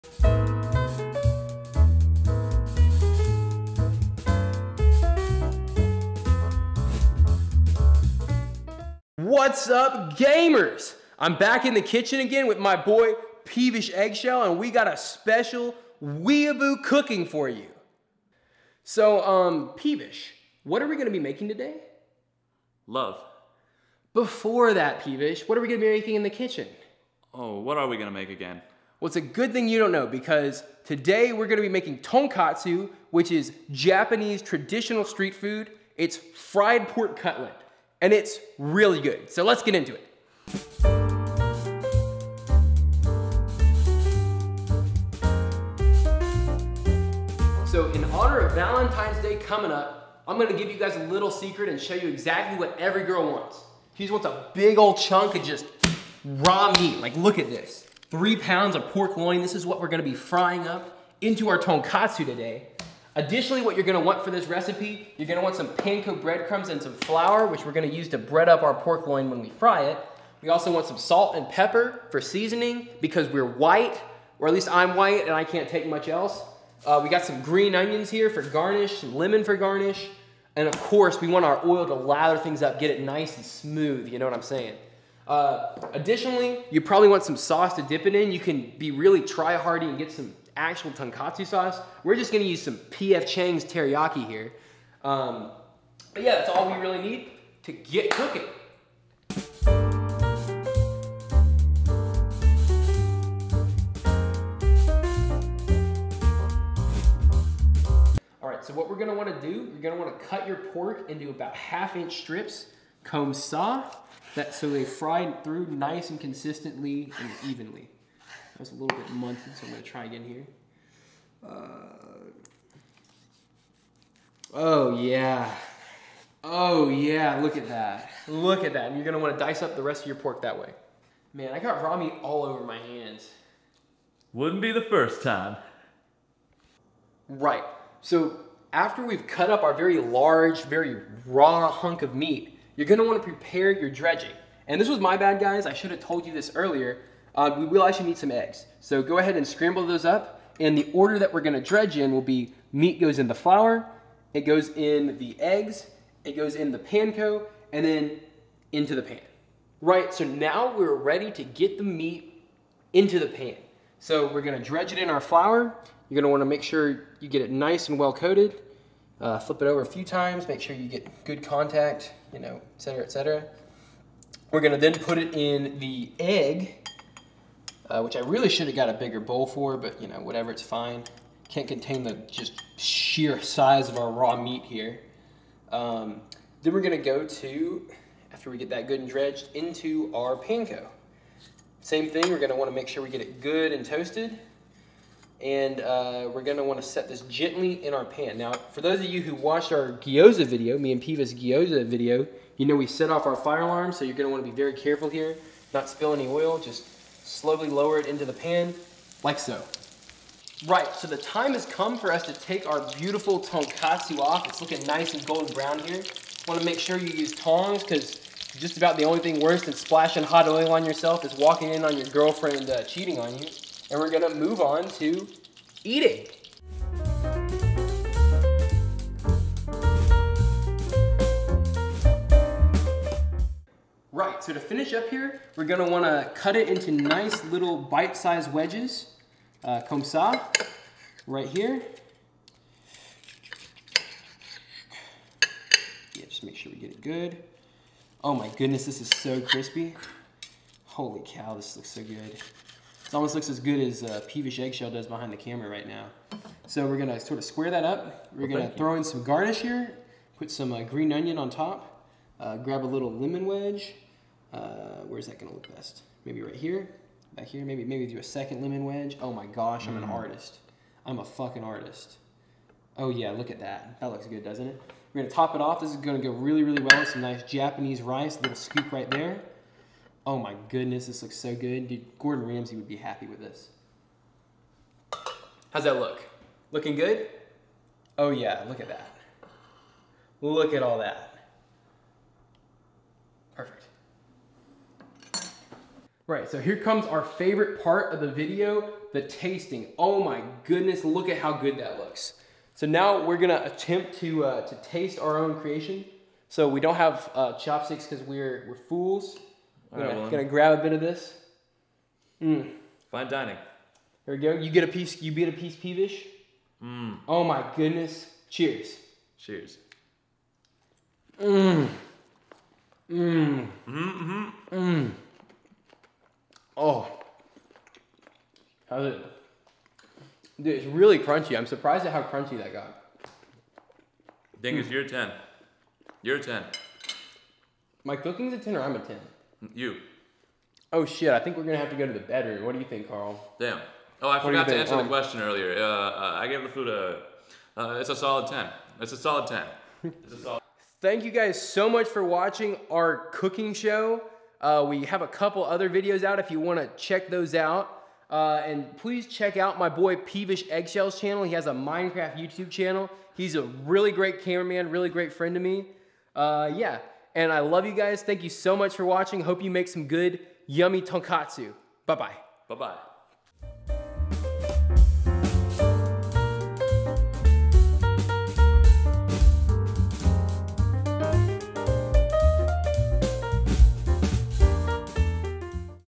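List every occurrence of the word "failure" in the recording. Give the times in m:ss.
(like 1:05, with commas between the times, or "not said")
not said.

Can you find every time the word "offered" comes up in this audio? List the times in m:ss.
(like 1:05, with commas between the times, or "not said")
not said.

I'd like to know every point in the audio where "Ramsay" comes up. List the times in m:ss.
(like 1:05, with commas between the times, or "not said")
4:42.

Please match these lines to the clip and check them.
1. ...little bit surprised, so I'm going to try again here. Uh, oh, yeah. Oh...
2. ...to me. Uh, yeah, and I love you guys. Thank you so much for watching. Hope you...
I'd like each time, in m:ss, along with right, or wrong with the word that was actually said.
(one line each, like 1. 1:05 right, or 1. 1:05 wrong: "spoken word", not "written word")
1. 1:58 wrong: "munted", not "surprised"
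2. 6:05 right.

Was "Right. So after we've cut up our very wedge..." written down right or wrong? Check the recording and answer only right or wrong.
wrong.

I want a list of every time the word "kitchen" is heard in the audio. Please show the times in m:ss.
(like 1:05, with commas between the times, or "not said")
0:11, 0:26.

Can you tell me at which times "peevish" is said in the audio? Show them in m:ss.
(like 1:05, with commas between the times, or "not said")
0:13, 0:19, 0:25, 4:14, 5:15, 6:00.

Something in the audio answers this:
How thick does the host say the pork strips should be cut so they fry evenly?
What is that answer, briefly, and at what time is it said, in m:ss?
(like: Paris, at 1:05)
half inch, at 1:51.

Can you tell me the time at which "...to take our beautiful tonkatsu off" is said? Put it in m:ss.
3:32.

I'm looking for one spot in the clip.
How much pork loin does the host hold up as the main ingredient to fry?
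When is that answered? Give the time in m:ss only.
0:58.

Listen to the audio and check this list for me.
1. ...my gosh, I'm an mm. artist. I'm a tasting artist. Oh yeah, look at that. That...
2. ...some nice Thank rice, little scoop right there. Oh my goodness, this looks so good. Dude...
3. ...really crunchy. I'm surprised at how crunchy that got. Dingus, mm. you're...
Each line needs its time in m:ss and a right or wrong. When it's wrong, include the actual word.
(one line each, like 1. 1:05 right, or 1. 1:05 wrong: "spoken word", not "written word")
1. 4:29 wrong: "fucking", not "tasting"
2. 4:37 wrong: "Japanese", not "Thank"
3. 5:30 right.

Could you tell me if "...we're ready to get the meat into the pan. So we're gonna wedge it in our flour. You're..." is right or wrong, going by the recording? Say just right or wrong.
wrong.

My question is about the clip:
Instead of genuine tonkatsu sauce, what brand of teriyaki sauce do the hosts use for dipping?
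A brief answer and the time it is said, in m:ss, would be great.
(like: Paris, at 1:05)
P.F. Chang's, at 1:32.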